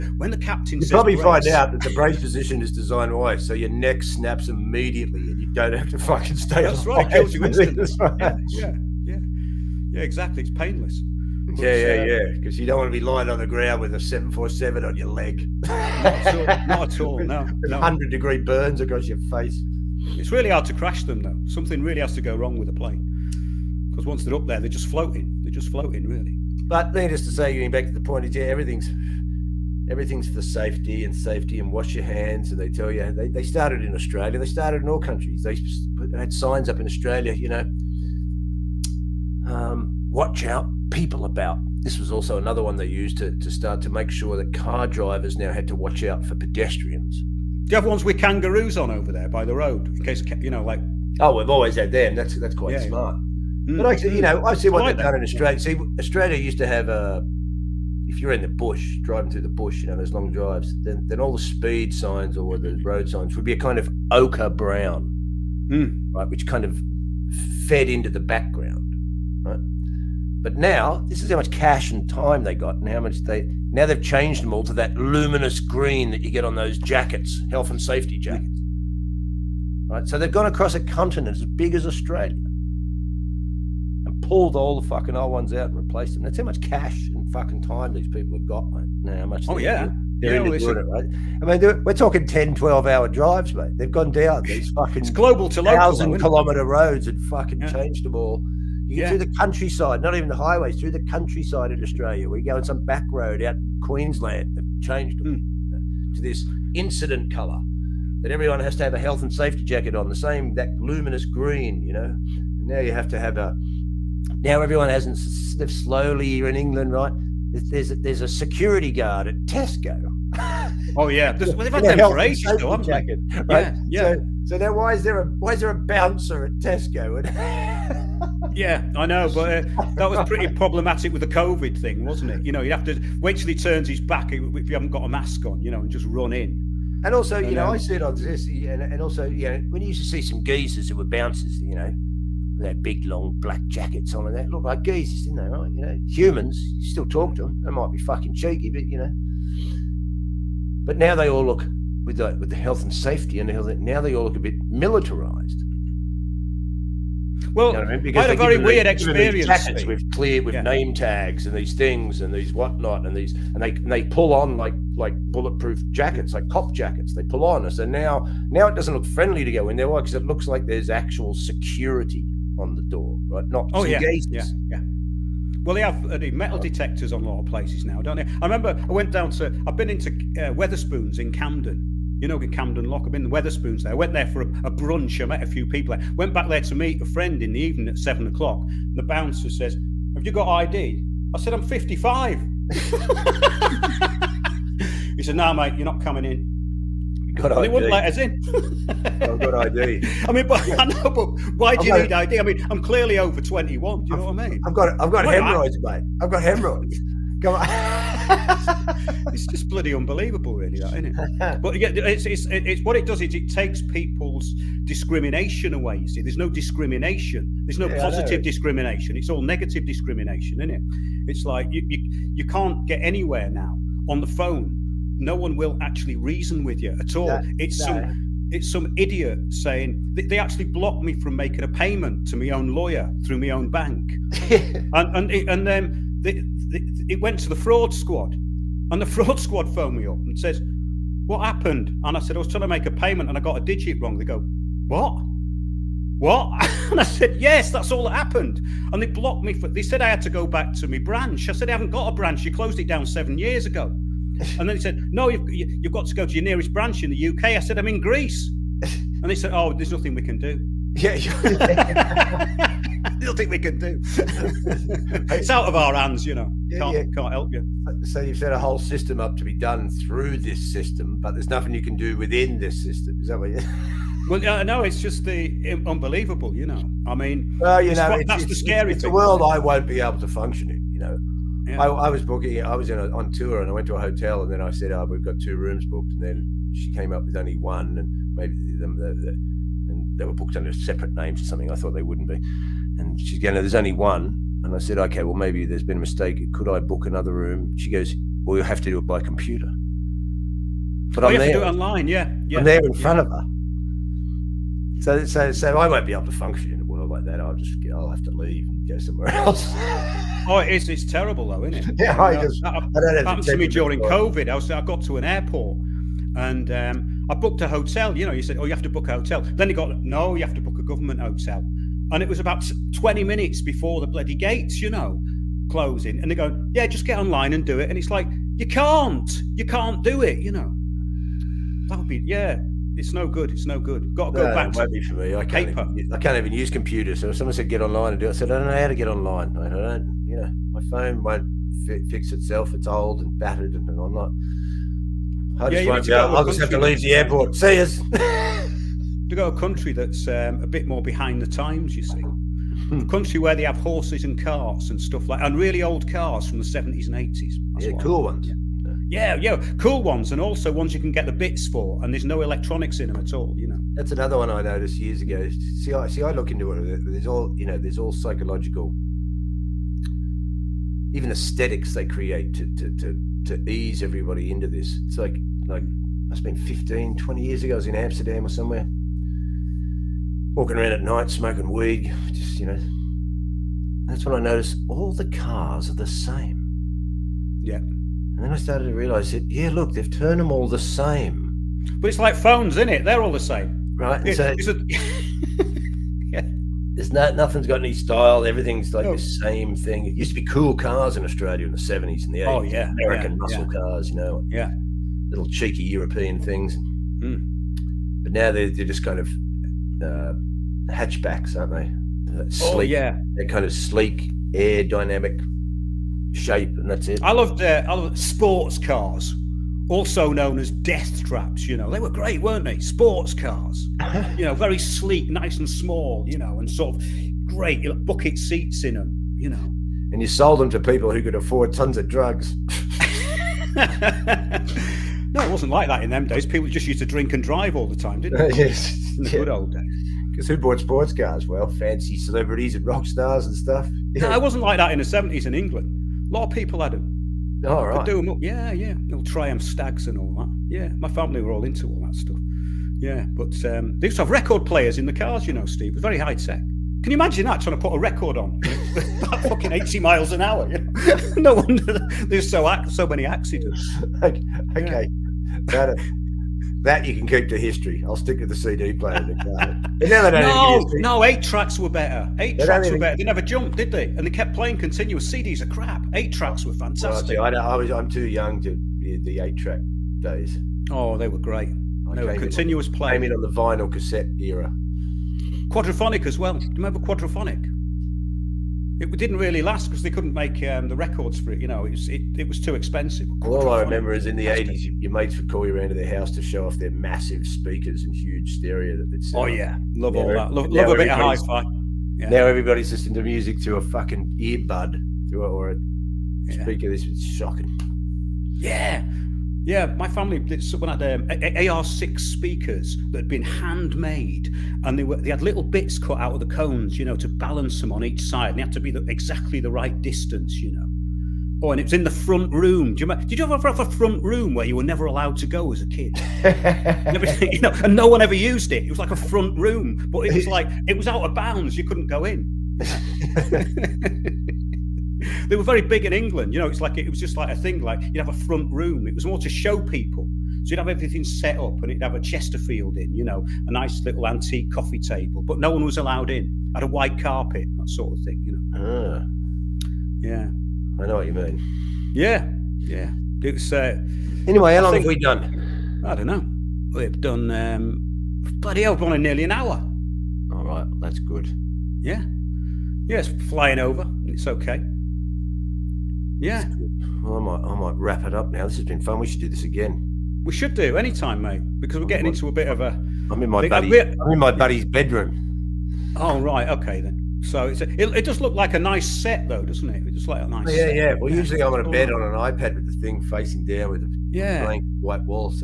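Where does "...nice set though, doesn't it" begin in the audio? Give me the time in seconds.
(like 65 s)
578 s.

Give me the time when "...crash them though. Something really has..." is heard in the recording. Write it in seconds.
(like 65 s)
20 s.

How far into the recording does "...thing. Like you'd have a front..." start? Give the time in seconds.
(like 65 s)
537 s.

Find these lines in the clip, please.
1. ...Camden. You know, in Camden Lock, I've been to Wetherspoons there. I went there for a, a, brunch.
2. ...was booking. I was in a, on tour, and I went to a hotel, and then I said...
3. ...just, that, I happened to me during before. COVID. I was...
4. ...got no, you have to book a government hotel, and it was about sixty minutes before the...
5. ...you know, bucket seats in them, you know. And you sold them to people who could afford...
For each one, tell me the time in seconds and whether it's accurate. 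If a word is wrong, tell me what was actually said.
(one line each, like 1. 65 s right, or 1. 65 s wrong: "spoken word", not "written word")
1. 181 s right
2. 282 s right
3. 312 s right
4. 319 s wrong: "twenty", not "sixty"
5. 427 s right.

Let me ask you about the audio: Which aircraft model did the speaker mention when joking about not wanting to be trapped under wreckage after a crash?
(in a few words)
747.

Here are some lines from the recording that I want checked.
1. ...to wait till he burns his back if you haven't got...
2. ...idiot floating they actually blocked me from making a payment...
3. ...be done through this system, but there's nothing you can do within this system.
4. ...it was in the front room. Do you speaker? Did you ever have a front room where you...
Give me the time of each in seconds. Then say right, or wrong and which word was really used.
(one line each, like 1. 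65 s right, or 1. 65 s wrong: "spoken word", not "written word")
1. 132 s wrong: "turns", not "burns"
2. 228 s wrong: "saying", not "floating"
3. 269 s right
4. 521 s wrong: "remember", not "speaker".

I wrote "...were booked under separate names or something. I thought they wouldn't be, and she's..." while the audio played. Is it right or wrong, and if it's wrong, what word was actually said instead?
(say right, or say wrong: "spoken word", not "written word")
right.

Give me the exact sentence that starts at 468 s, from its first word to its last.
I'll stick to the CD player in the car.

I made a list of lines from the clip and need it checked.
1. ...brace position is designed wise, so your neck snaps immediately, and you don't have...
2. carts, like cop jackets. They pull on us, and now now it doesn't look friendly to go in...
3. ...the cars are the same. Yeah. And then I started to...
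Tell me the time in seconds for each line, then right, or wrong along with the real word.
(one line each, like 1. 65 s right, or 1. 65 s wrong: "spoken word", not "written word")
1. 1 s right
2. 165 s wrong: "jackets", not "carts"
3. 385 s right.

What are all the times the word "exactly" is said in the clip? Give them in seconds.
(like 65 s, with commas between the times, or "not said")
10 s, 519 s.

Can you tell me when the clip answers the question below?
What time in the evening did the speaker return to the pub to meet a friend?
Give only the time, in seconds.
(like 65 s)
187 s.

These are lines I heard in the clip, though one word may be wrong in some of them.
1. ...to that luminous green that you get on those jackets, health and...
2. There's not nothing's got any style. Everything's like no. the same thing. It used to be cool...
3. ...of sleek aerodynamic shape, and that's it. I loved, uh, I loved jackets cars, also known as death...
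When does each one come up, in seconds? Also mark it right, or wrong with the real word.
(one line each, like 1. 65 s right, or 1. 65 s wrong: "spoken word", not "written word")
1. 74 s right
2. 396 s right
3. 413 s wrong: "sports", not "jackets".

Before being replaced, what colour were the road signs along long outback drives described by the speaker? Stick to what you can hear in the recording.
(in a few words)
Ochre brown.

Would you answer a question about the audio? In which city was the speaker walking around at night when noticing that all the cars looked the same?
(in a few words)
Amsterdam.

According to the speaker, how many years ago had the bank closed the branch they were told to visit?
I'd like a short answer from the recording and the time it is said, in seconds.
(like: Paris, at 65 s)
7 years, at 253 s.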